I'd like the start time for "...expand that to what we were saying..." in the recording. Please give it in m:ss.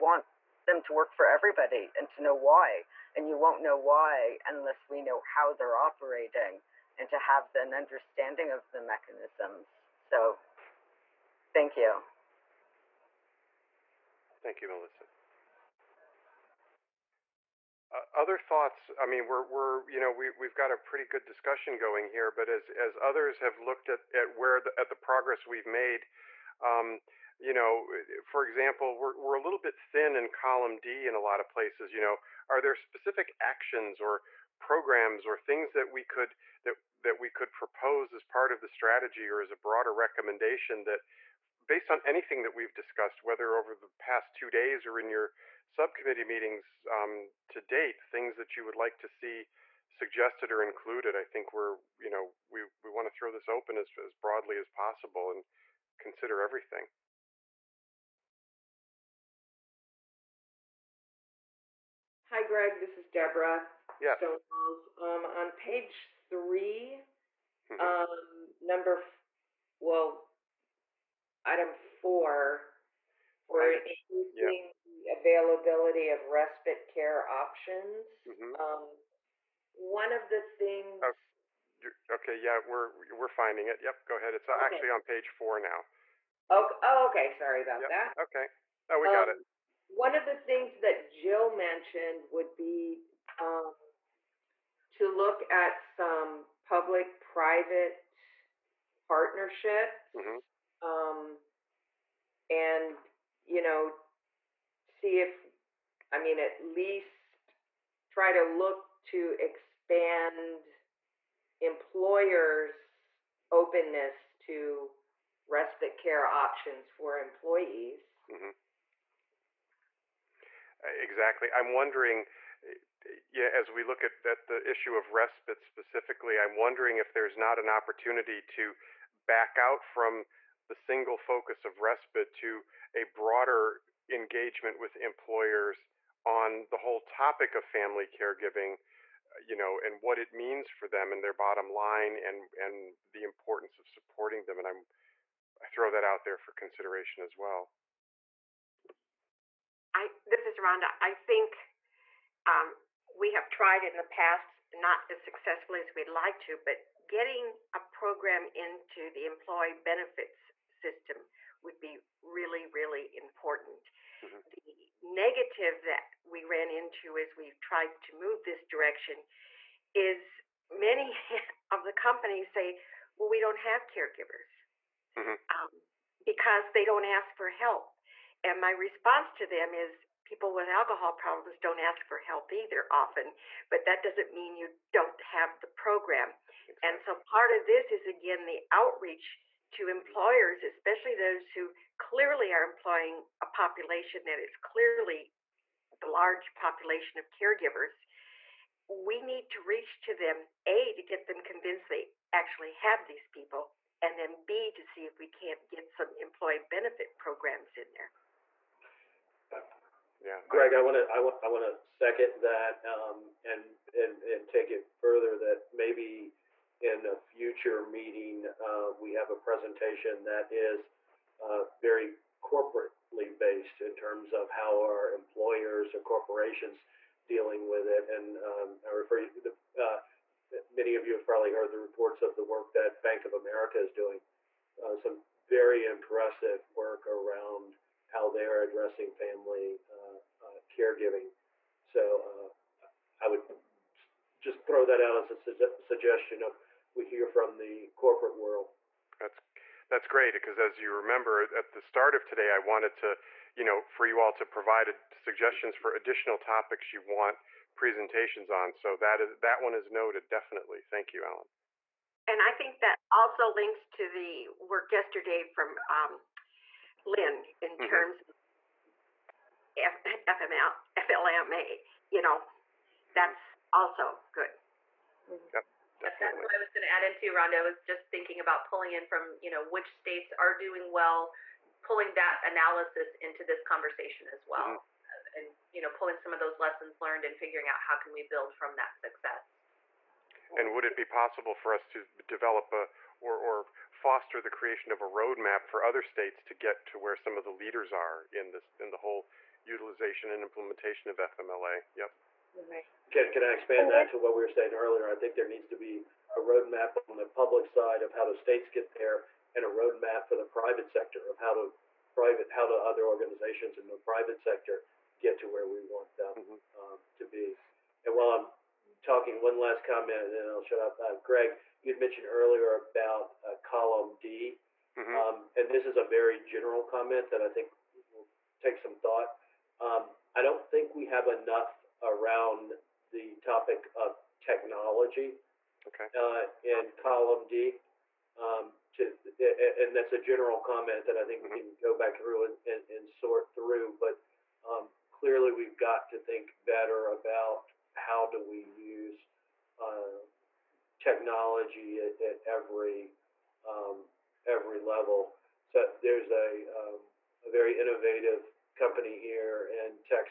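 5:03.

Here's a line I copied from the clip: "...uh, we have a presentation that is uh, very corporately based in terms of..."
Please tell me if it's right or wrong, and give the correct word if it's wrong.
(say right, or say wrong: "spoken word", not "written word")
right.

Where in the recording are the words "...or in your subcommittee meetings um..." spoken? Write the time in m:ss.
0:44.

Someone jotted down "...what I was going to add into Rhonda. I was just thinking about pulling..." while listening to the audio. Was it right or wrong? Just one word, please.
right.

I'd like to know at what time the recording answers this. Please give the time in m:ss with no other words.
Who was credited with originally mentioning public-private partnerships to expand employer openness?
1:31.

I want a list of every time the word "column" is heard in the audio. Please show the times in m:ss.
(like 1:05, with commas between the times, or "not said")
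0:30, 5:23, 5:36.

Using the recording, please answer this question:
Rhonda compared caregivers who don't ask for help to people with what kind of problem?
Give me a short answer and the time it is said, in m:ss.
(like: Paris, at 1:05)
Alcohol problems, at 3:00.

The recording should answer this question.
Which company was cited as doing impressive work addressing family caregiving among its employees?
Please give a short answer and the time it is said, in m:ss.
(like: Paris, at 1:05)
Bank of America, at 3:53.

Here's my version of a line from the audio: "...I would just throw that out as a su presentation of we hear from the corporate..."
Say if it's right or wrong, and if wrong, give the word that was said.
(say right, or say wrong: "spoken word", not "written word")
wrong: "suggestion", not "presentation".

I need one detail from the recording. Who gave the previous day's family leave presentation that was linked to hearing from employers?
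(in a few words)
Lynn.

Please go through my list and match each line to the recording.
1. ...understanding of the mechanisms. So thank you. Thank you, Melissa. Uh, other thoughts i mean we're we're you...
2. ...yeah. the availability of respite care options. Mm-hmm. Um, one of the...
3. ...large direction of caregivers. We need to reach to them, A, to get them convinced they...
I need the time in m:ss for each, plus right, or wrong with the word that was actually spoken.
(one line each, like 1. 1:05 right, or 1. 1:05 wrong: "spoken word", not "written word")
1. 0:07 right
2. 1:14 right
3. 3:16 wrong: "population", not "direction".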